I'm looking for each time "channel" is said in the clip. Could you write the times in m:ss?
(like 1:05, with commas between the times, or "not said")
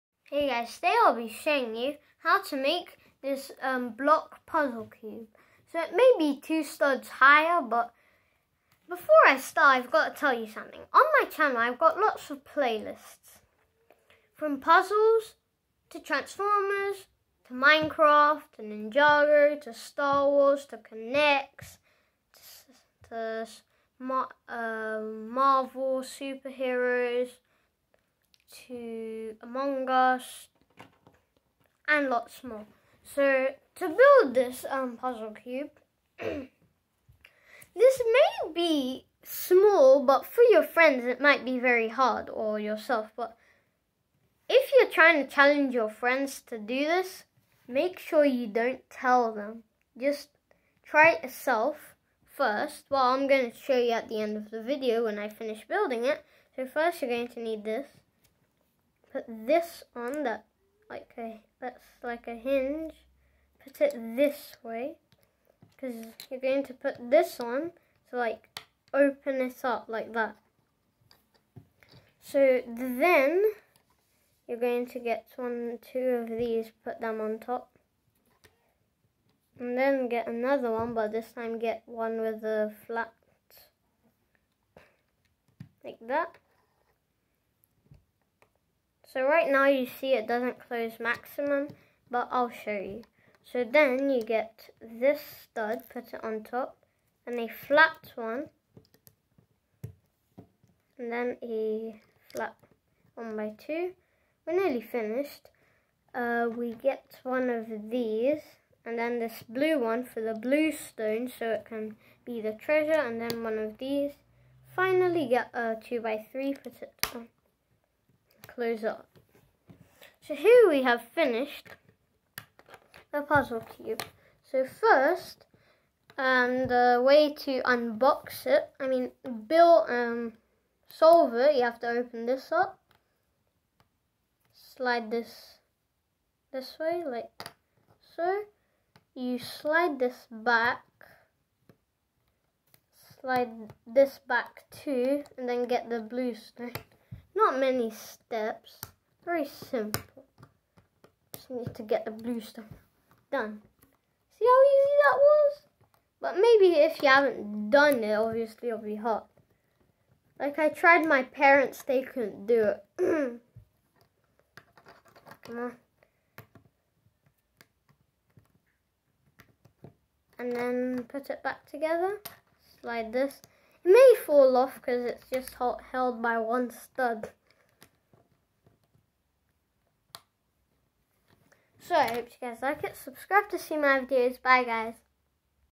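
0:11.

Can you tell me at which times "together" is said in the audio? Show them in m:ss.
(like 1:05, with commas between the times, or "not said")
2:51.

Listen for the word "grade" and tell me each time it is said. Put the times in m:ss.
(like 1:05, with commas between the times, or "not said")
not said.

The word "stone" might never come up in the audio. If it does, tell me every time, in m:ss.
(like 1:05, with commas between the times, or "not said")
1:50, 2:26.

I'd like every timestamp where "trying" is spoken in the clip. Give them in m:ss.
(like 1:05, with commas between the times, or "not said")
0:44.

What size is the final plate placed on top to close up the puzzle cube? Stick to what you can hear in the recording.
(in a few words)
2 by 3.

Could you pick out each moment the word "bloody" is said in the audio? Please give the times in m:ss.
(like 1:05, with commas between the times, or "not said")
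not said.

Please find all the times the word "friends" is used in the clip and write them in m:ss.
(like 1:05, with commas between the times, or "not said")
0:40, 0:45.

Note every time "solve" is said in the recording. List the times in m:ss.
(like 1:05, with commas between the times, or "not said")
2:10.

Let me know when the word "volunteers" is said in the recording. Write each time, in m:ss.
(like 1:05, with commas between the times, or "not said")
not said.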